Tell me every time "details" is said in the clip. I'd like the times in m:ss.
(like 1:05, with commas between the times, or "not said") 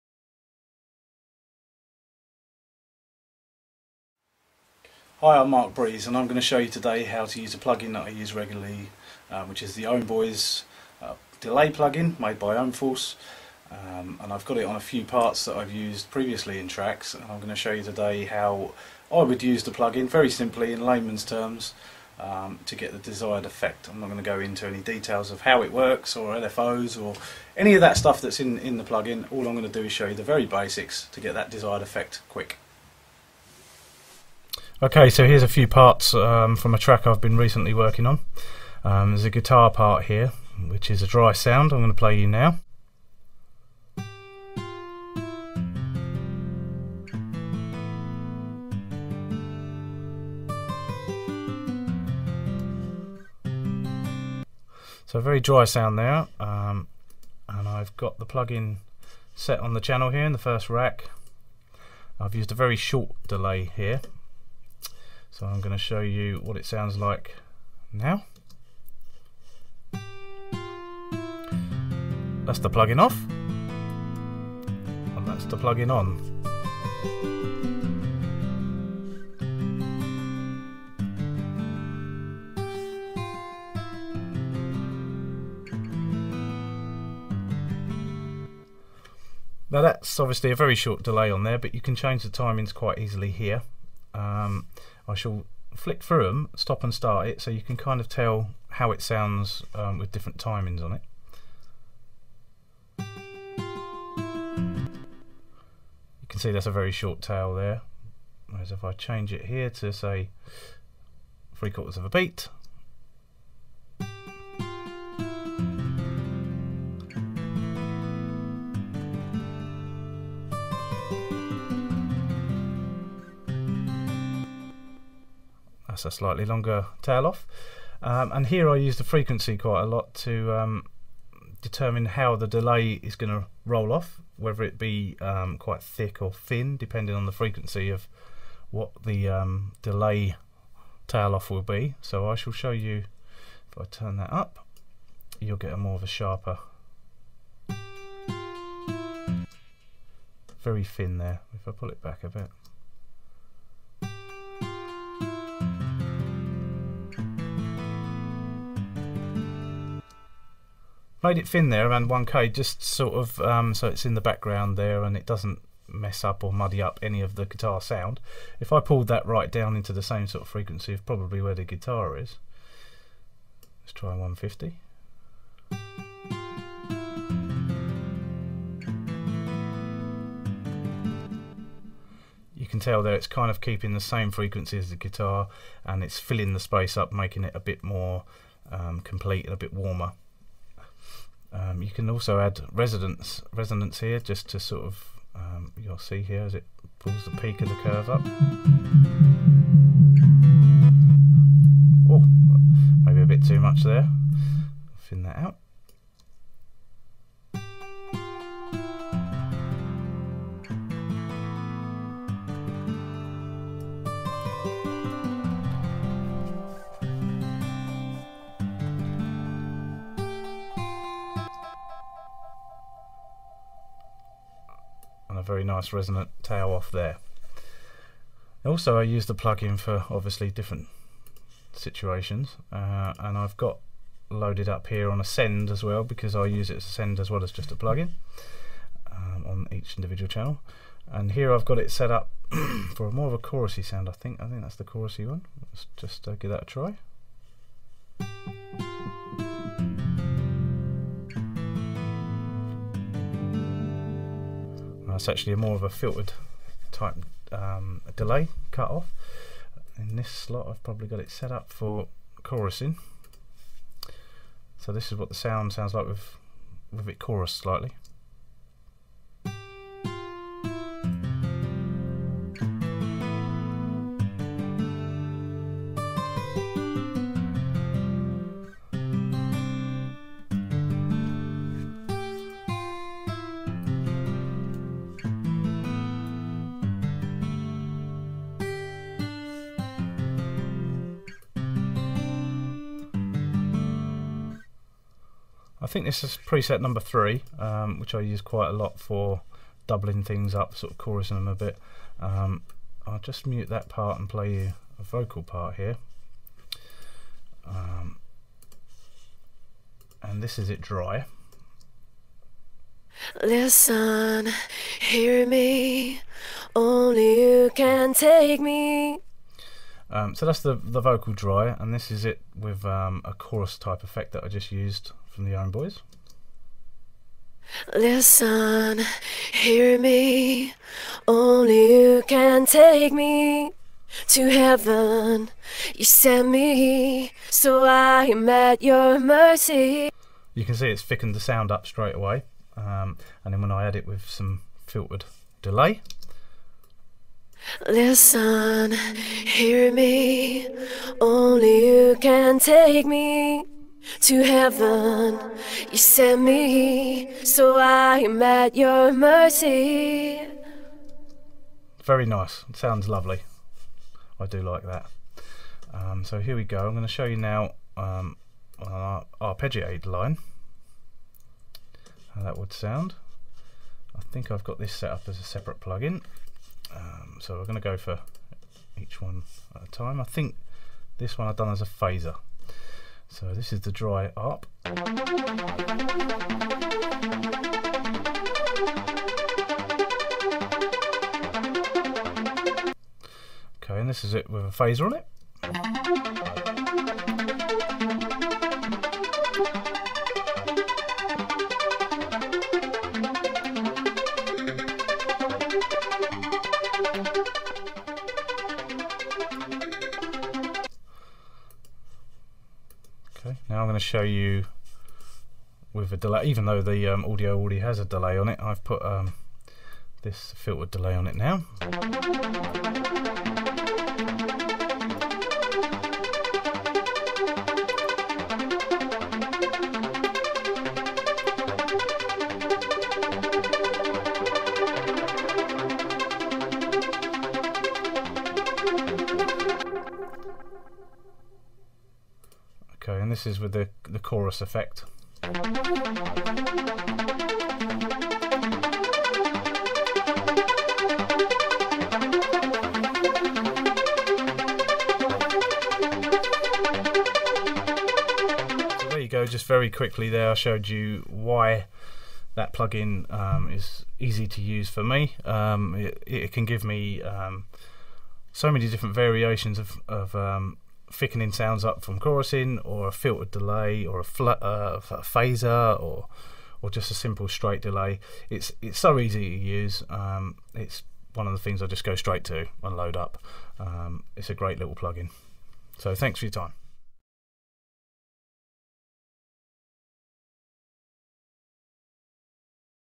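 0:24.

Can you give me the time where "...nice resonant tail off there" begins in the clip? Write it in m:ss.
3:45.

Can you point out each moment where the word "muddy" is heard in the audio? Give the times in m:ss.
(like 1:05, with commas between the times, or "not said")
2:46.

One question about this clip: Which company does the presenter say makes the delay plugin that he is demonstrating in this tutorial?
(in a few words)
Ohm Force.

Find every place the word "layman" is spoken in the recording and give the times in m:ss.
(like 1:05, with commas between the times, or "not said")
0:20.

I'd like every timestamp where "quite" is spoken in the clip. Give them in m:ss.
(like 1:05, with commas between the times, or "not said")
1:32, 2:09, 2:15, 4:58.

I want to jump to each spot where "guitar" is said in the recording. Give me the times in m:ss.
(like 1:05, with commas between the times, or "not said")
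0:39, 2:47, 2:51, 3:04.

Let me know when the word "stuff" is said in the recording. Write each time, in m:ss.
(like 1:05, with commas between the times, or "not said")
0:27.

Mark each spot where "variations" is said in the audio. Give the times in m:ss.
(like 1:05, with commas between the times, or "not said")
7:49.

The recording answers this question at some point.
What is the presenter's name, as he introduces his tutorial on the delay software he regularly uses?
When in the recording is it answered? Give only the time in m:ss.
0:05.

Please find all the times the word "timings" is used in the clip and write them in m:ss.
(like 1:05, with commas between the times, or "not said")
1:32, 1:40.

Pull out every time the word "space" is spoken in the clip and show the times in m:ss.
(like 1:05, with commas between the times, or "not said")
3:06.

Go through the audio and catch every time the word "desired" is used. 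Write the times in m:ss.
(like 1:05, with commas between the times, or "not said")
0:22, 0:31.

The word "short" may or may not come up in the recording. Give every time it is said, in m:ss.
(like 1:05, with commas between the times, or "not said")
1:02, 1:30, 1:46.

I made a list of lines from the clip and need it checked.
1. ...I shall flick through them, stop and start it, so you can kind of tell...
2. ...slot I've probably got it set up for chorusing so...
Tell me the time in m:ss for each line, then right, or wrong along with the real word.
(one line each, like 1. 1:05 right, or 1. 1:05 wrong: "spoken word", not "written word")
1. 1:35 right
2. 4:20 right.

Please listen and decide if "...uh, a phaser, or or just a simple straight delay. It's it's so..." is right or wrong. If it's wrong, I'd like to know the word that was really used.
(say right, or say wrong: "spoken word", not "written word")
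right.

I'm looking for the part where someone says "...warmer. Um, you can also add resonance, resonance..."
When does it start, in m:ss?
3:09.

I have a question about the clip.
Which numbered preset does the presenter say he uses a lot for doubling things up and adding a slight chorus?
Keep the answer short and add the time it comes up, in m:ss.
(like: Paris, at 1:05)
3, at 4:56.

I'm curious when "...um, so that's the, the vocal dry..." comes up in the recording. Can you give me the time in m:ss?
5:20.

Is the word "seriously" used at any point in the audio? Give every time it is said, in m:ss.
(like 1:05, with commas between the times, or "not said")
not said.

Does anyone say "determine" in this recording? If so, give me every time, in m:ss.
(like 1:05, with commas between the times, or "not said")
2:11.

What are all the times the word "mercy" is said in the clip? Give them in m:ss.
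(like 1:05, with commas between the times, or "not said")
5:39, 5:59.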